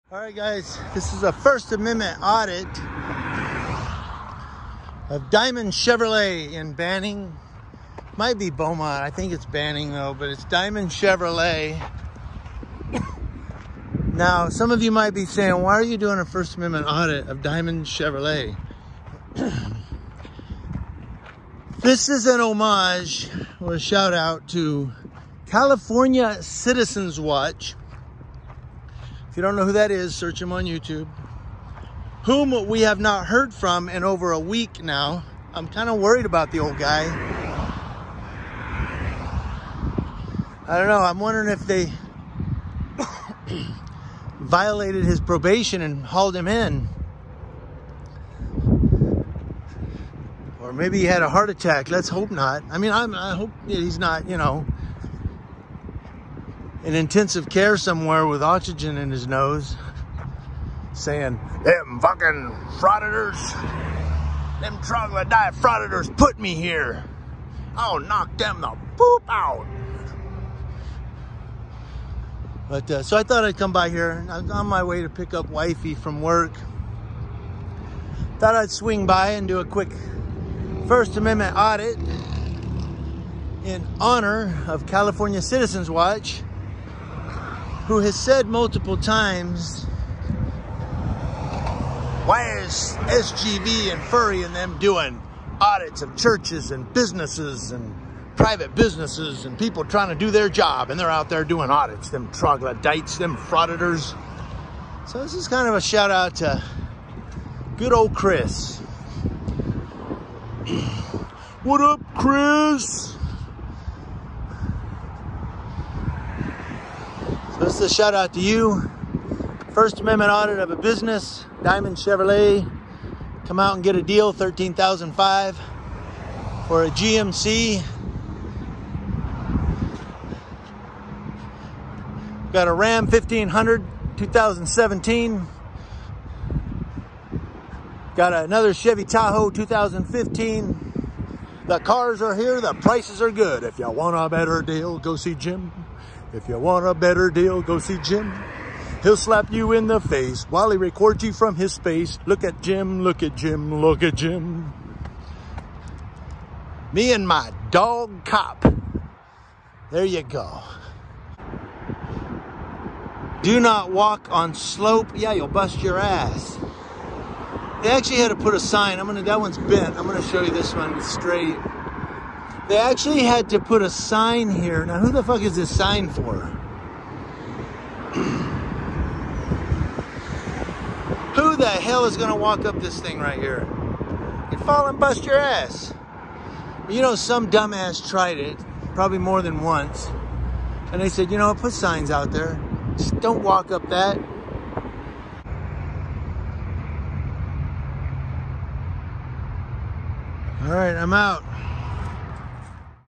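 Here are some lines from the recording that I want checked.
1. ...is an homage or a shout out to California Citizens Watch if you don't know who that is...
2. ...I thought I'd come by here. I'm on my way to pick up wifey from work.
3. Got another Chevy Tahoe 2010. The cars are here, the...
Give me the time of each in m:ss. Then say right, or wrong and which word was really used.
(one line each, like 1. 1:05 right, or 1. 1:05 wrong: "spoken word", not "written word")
1. 0:22 right
2. 1:13 right
3. 2:18 wrong: "2015", not "2010".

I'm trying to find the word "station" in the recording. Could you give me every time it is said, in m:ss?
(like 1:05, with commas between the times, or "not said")
not said.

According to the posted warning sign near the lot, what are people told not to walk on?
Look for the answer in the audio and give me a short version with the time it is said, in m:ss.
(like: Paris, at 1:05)
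Slope, at 2:44.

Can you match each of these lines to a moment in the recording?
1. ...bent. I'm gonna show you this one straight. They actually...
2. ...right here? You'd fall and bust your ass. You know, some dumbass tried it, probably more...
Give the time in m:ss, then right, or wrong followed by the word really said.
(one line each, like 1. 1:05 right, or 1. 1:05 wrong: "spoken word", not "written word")
1. 2:49 right
2. 3:03 right.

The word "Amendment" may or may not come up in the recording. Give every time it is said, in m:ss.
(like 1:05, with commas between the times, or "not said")
0:01, 0:16, 1:21, 2:00.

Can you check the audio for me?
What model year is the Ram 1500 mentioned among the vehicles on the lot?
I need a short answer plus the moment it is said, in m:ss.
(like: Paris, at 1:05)
2017, at 2:14.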